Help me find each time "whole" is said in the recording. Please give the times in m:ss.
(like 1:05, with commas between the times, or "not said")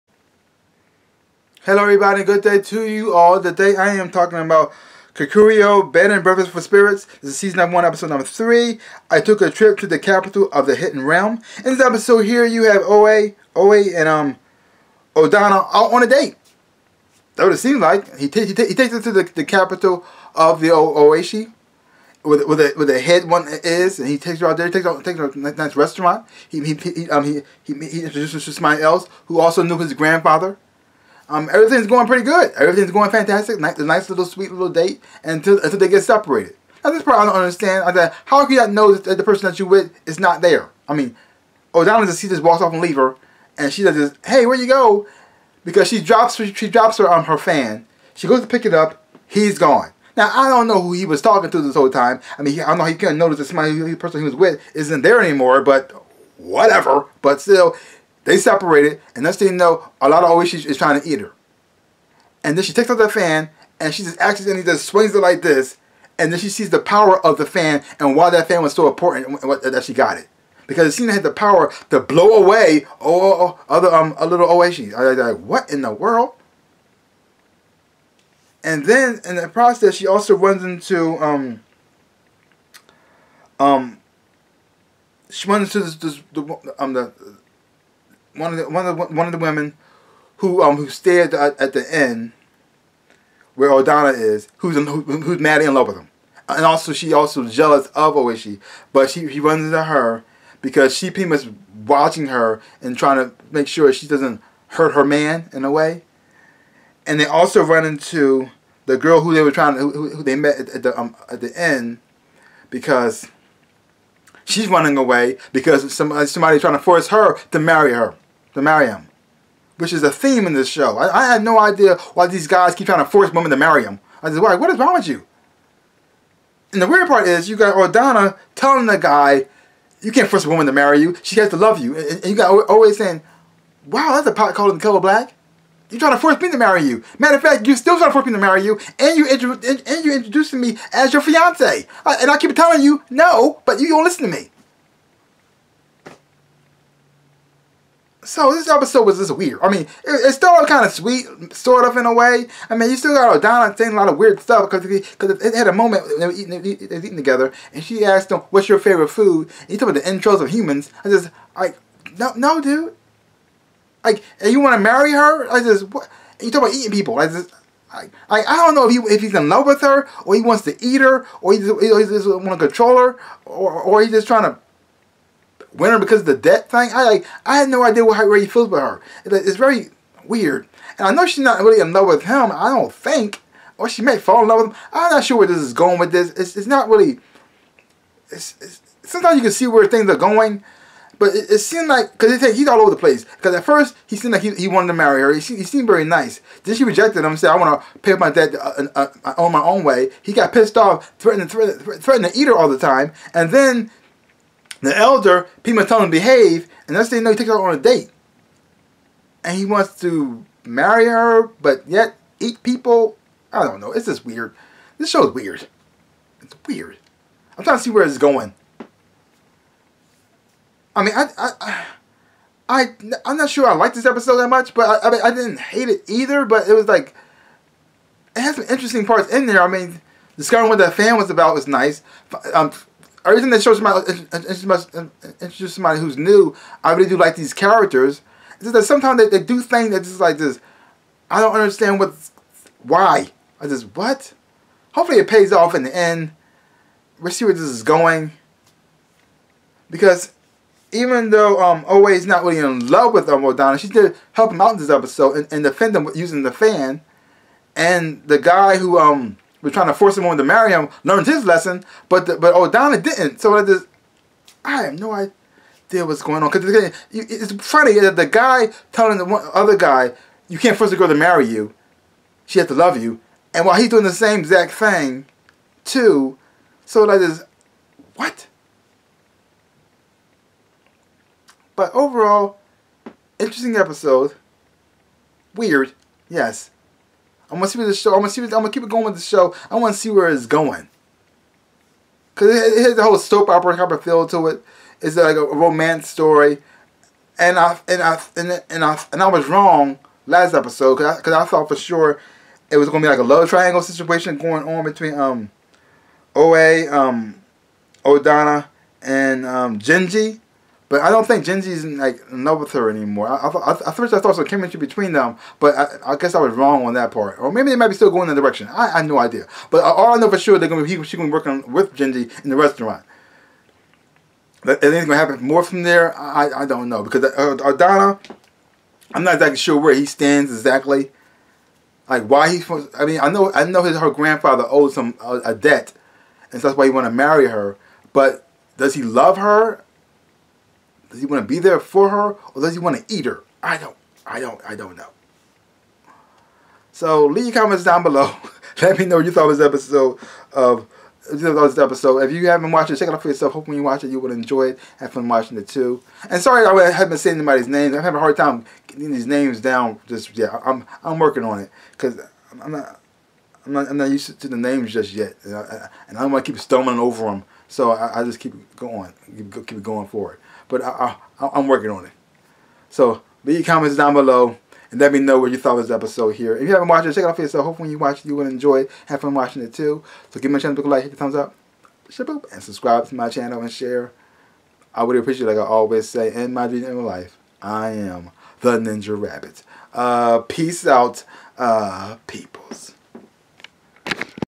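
0:51, 4:53.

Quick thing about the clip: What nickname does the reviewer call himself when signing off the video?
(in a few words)
The Ninja Rabbit.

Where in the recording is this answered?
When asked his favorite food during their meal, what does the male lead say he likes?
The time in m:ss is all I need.
2:39.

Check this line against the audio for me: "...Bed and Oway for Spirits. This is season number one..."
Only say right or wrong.
wrong.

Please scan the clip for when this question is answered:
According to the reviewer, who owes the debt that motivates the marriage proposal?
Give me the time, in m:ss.
5:33.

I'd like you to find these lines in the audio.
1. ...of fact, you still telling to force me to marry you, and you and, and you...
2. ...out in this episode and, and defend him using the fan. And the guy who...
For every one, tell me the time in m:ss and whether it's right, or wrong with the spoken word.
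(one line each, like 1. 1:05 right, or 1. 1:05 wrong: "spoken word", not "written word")
1. 2:17 wrong: "trying", not "telling"
2. 4:14 right.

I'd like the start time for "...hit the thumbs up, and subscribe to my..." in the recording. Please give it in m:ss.
6:21.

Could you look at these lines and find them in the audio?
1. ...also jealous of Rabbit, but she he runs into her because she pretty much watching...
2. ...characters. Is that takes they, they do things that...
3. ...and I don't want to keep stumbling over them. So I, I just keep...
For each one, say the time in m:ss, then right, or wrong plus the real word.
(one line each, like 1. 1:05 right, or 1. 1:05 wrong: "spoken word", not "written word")
1. 1:37 wrong: "Oishi", not "Rabbit"
2. 3:57 wrong: "sometimes", not "takes"
3. 6:06 right.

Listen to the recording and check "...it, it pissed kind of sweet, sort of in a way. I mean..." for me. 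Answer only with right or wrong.
wrong.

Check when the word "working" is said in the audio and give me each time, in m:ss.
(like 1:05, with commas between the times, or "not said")
5:21, 6:01, 6:11.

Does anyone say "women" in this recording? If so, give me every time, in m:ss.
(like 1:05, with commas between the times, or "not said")
1:29, 2:03.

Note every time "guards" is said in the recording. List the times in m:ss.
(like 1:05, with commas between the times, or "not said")
not said.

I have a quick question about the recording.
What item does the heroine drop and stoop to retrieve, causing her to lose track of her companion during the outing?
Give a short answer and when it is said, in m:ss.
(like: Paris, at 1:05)
Her fan, at 0:47.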